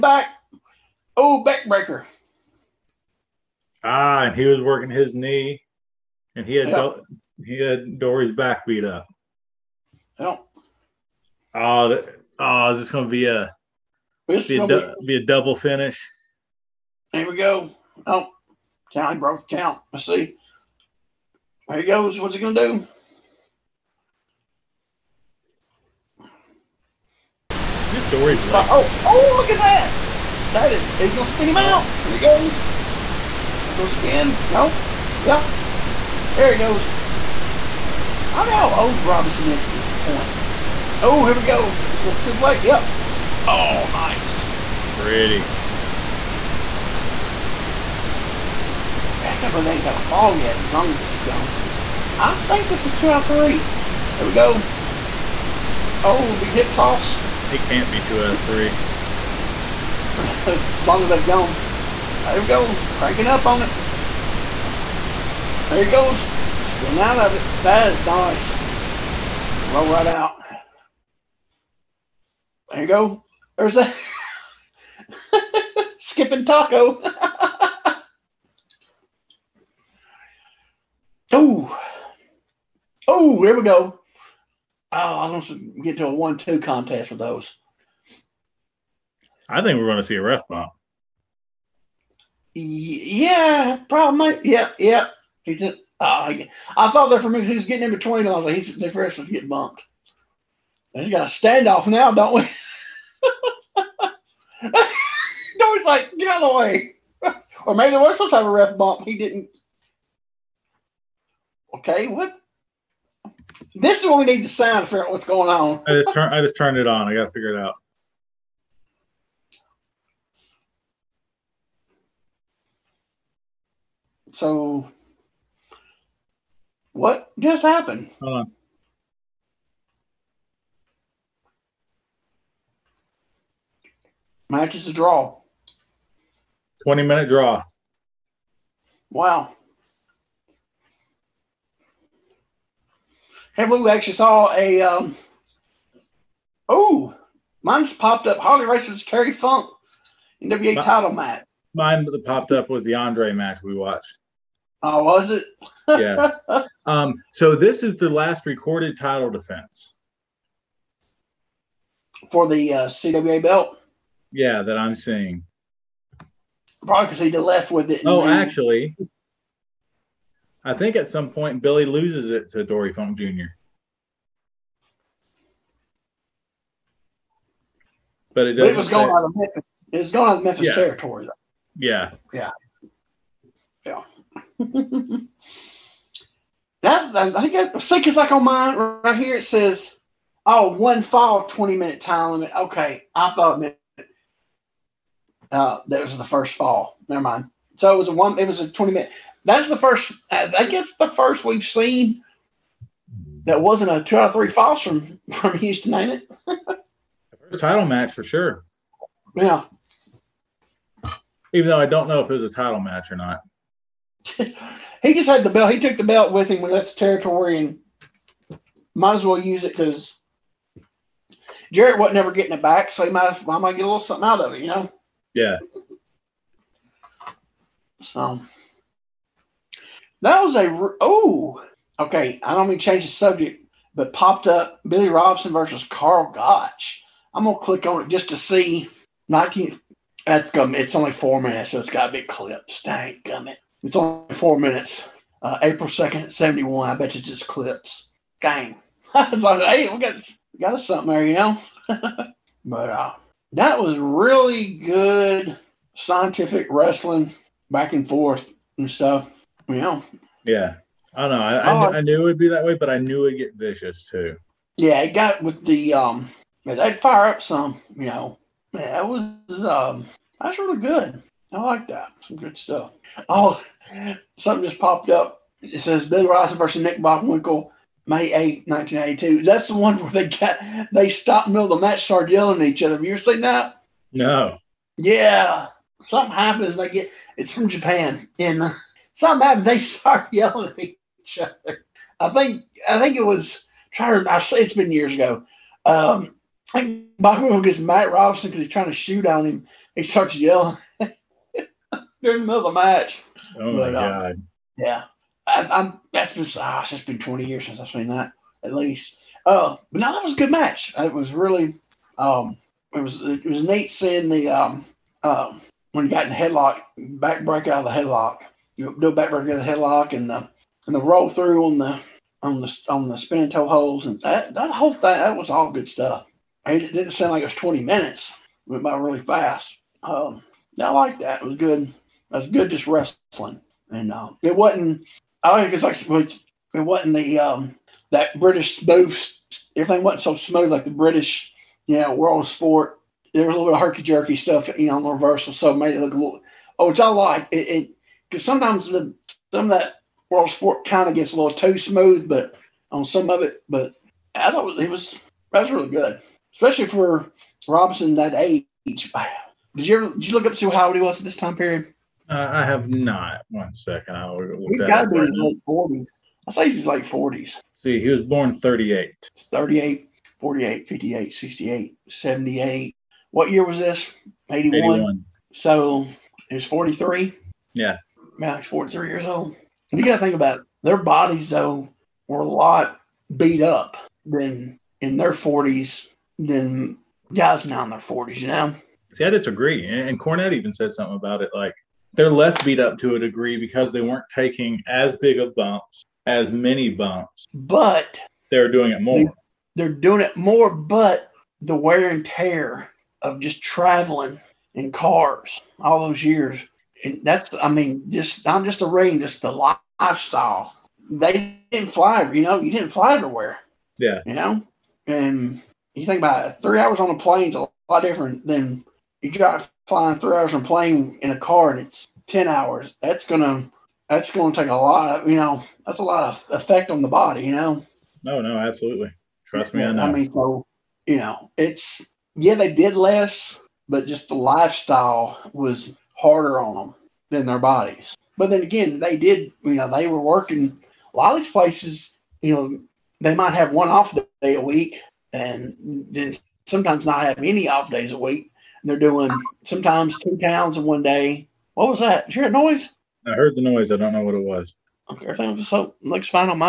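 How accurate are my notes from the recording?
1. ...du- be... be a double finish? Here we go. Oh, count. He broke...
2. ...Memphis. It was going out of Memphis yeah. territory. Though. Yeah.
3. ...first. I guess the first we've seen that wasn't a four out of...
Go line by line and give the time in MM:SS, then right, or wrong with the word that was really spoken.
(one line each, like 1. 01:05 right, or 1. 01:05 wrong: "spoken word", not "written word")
1. 00:14 right
2. 02:59 right
3. 03:19 wrong: "two", not "four".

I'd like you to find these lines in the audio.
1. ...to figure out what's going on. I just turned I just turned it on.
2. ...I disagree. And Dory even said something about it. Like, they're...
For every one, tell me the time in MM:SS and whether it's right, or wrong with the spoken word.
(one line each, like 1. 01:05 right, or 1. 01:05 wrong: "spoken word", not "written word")
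1. 01:54 right
2. 06:29 wrong: "Cornette", not "Dory".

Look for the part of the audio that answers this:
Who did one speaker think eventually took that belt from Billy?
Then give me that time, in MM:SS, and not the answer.
02:52.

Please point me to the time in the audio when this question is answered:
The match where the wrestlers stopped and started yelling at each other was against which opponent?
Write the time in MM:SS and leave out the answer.
04:36.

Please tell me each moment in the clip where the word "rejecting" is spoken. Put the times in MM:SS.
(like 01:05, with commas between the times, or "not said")
not said.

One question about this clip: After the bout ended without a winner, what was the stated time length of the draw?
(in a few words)
20 minutes.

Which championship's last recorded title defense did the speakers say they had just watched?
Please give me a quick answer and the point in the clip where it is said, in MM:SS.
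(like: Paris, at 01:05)
CWA, at 02:42.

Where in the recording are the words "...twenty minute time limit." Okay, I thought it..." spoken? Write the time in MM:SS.
03:11.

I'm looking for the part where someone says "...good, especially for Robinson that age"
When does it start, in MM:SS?
05:55.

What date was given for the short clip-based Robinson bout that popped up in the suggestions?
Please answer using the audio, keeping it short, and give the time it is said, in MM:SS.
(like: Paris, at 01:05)
April 2nd, 1971, at 04:05.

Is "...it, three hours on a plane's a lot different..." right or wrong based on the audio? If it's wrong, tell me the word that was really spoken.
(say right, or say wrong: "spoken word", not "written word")
right.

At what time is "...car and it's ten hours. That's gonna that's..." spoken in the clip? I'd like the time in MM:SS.
07:01.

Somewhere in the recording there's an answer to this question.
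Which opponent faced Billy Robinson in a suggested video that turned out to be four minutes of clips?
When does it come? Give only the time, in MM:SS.
03:55.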